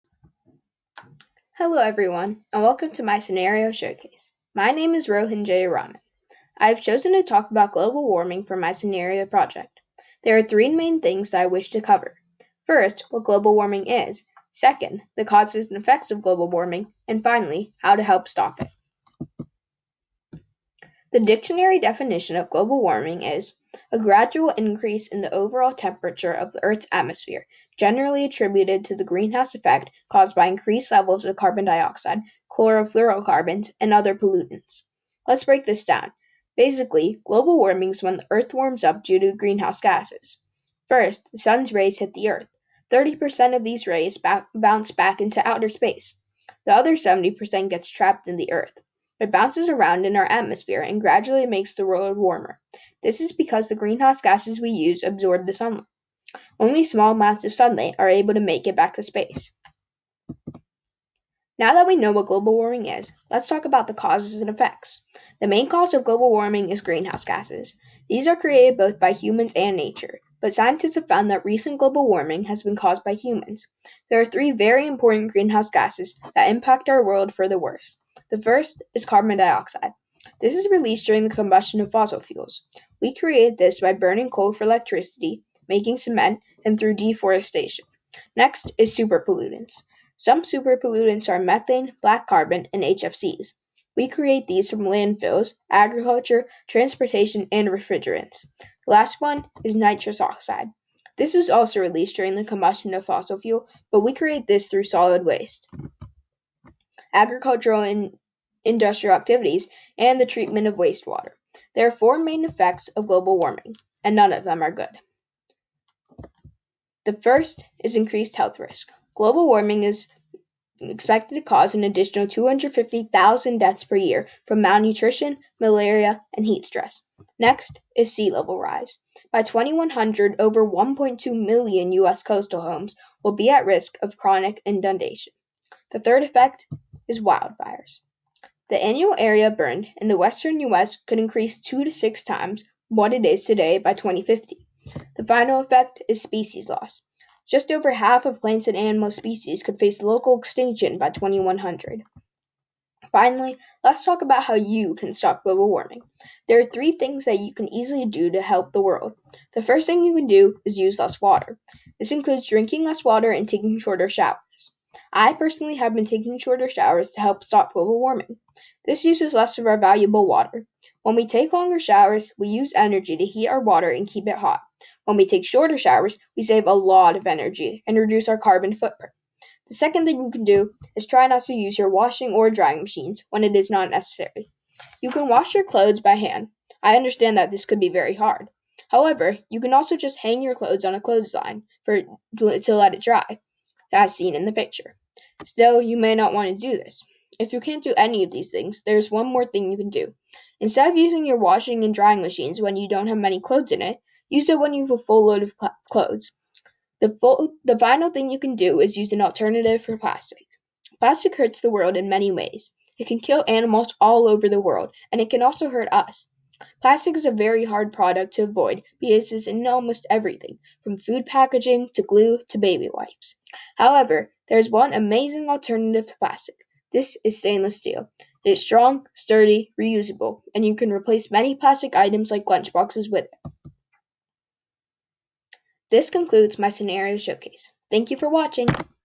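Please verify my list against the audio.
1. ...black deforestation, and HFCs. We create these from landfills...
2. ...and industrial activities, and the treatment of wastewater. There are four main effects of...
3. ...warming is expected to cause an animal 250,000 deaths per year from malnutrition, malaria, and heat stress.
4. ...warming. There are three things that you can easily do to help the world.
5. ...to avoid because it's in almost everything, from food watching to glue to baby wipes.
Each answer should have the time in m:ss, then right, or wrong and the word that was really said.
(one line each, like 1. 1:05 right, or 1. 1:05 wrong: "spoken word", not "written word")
1. 1:32 wrong: "carbon", not "deforestation"
2. 1:47 right
3. 1:59 wrong: "additional", not "animal"
4. 2:35 right
5. 3:38 wrong: "packaging", not "watching".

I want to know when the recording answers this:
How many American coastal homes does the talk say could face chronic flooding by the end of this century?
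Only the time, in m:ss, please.
2:10.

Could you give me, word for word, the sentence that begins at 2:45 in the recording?
I personally have been taking shorter showers to help stop global warming.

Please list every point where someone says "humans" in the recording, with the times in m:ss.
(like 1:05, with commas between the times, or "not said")
1:09, 1:13.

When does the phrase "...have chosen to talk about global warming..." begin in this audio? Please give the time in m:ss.
0:06.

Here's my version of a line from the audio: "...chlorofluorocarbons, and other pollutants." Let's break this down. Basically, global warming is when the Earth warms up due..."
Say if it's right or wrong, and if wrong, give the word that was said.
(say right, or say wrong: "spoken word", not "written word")
right.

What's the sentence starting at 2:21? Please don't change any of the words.
could increase two to six times what it is today by 2050.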